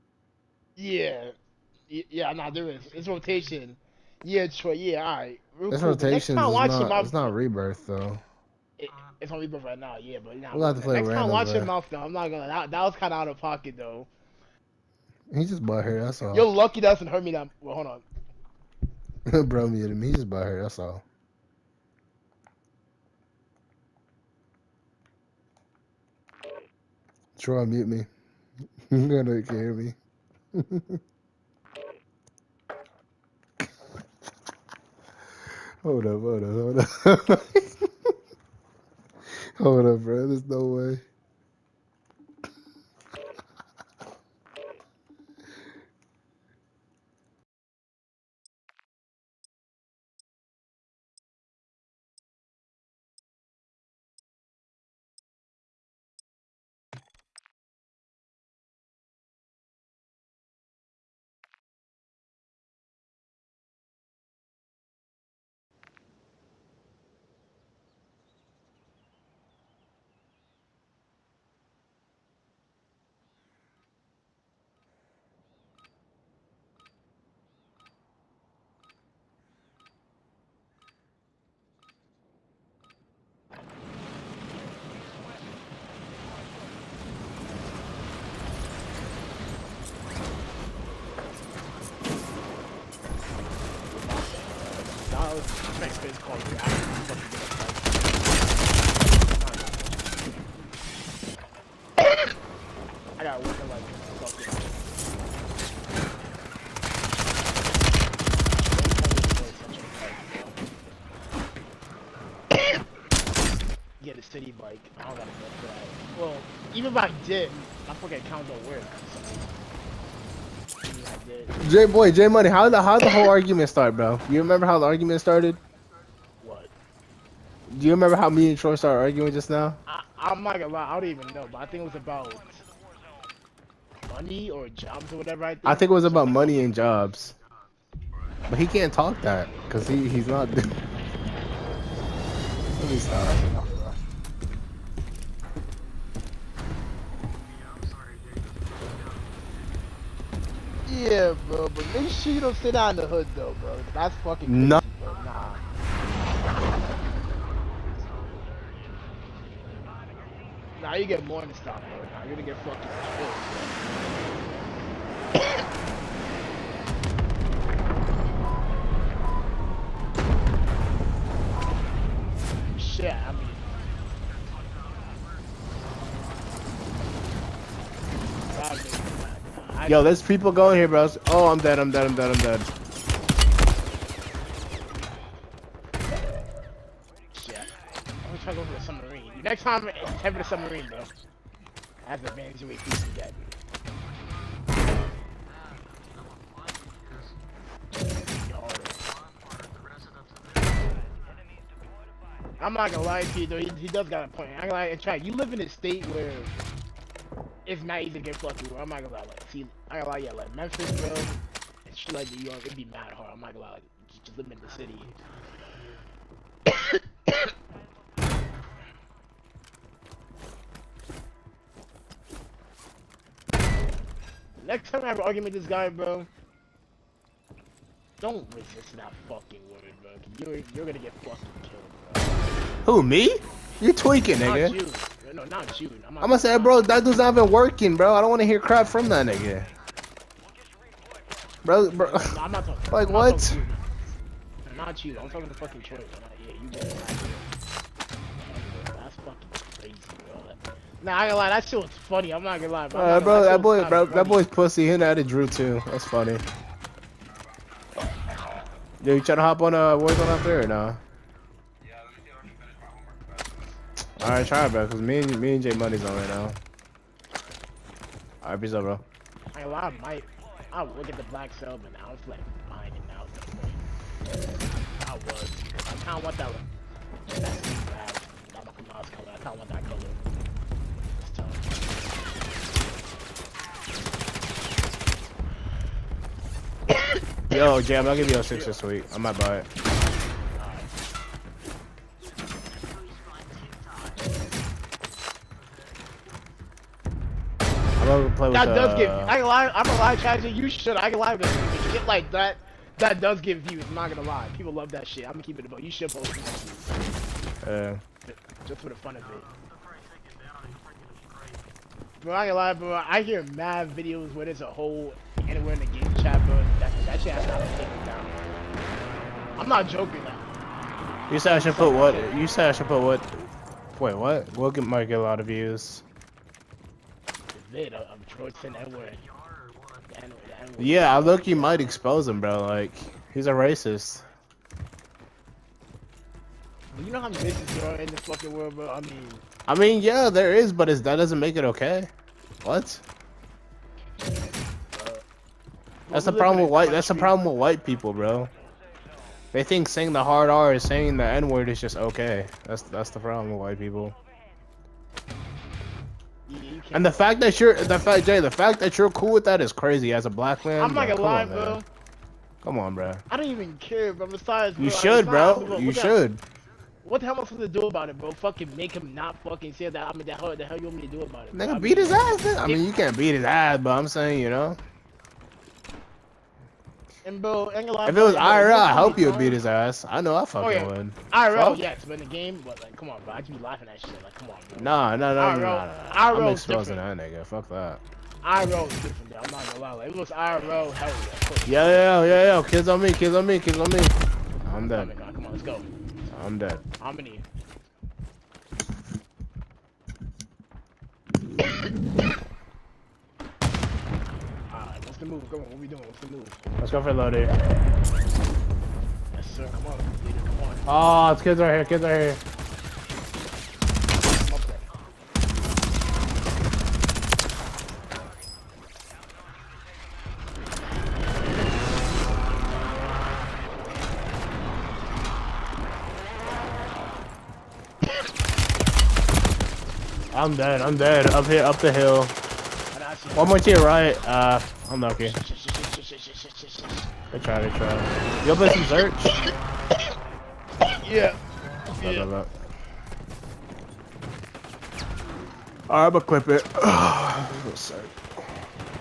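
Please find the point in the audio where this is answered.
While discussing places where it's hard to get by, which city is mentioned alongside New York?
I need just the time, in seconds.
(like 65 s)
210 s.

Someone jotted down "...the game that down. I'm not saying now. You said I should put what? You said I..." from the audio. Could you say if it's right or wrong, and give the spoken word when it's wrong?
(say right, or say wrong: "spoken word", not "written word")
wrong: "joking", not "saying".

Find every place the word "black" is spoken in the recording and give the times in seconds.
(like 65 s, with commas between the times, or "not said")
271 s, 360 s.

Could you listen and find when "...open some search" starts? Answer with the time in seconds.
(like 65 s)
438 s.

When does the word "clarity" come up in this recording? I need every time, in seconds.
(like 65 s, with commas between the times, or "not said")
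not said.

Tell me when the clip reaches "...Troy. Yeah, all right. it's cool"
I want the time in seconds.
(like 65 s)
4 s.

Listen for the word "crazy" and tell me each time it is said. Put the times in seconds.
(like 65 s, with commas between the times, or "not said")
154 s, 359 s.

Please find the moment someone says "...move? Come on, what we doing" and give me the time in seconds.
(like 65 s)
405 s.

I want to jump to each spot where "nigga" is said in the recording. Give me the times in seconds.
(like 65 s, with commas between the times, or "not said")
234 s, 239 s, 371 s, 387 s.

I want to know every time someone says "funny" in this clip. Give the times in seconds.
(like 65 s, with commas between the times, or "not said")
251 s, 256 s.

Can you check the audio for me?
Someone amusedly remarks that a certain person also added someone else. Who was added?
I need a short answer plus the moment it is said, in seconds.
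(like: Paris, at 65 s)
Drew, at 255 s.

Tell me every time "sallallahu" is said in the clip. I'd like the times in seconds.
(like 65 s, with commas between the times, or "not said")
not said.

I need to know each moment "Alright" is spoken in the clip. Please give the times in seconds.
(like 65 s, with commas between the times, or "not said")
264 s, 268 s, 445 s.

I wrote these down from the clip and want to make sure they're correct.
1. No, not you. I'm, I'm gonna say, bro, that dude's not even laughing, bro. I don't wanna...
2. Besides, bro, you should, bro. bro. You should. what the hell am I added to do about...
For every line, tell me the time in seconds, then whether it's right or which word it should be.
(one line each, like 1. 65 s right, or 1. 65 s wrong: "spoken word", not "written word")
1. 235 s wrong: "working", not "laughing"
2. 364 s wrong: "supposed", not "added".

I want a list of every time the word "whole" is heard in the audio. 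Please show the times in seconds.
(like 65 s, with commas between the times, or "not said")
123 s.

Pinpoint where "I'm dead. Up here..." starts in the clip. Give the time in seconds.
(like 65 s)
430 s.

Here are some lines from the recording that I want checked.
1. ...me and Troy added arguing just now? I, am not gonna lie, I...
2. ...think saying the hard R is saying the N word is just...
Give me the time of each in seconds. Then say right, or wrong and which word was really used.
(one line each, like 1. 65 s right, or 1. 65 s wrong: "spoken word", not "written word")
1. 128 s wrong: "started", not "added"
2. 349 s right.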